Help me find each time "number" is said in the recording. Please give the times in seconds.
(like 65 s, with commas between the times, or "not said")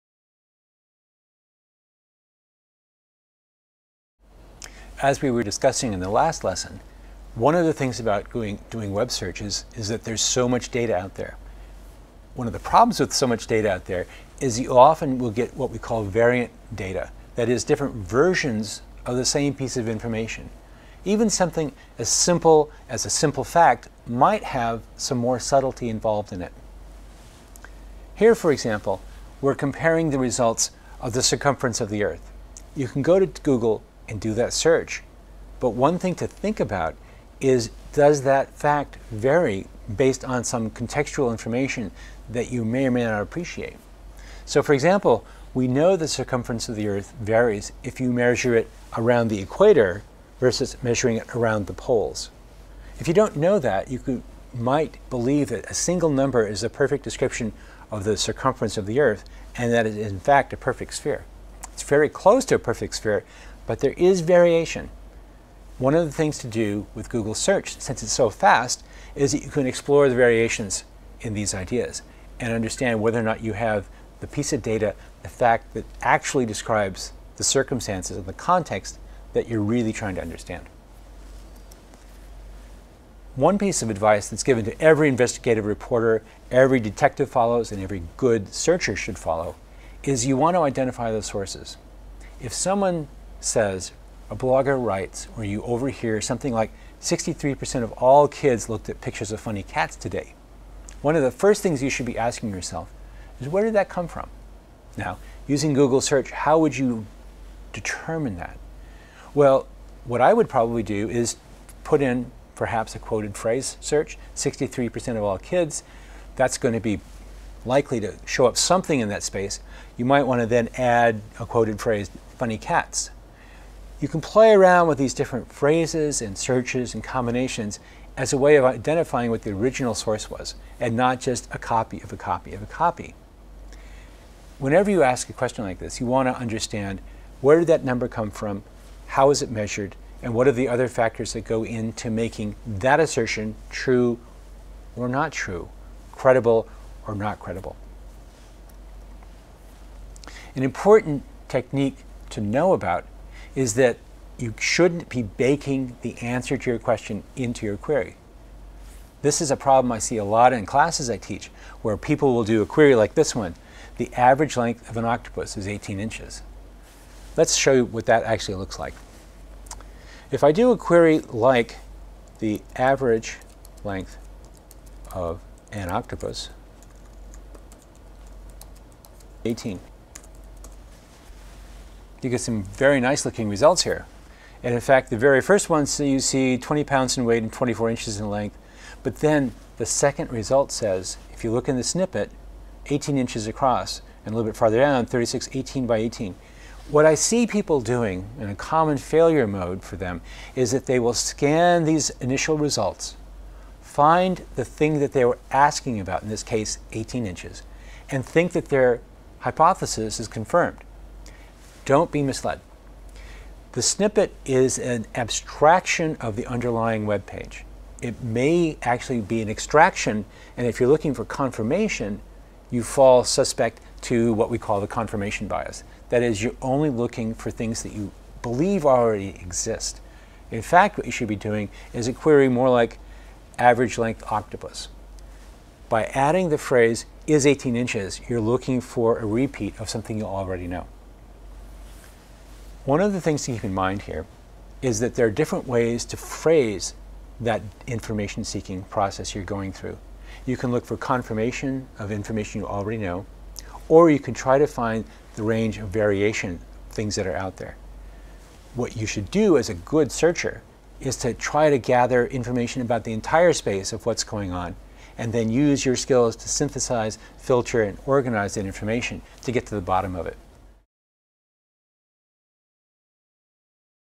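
56 s, 137 s.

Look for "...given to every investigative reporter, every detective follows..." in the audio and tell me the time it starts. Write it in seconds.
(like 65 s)
84 s.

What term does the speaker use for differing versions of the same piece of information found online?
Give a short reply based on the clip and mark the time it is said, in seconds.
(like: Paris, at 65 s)
variant data, at 16 s.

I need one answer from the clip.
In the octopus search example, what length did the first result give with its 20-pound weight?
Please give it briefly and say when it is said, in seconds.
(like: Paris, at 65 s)
24 inches, at 187 s.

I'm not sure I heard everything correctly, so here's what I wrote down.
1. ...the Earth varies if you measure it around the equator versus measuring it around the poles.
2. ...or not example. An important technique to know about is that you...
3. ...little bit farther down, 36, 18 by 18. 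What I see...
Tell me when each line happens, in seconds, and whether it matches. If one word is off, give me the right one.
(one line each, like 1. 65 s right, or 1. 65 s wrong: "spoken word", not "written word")
1. 46 s right
2. 147 s wrong: "credible", not "example"
3. 194 s right.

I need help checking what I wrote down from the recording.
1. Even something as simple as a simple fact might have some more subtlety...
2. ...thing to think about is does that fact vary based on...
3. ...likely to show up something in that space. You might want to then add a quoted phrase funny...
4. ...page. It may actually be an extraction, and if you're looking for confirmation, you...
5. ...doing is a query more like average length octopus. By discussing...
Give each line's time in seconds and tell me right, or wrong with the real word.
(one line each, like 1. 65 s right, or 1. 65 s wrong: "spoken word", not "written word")
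1. 21 s right
2. 35 s right
3. 117 s right
4. 217 s right
5. 231 s wrong: "adding", not "discussing".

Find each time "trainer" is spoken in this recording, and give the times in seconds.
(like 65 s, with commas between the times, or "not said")
not said.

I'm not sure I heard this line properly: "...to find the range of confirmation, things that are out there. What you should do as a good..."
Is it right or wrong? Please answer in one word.
wrong.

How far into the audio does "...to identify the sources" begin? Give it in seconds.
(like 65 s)
90 s.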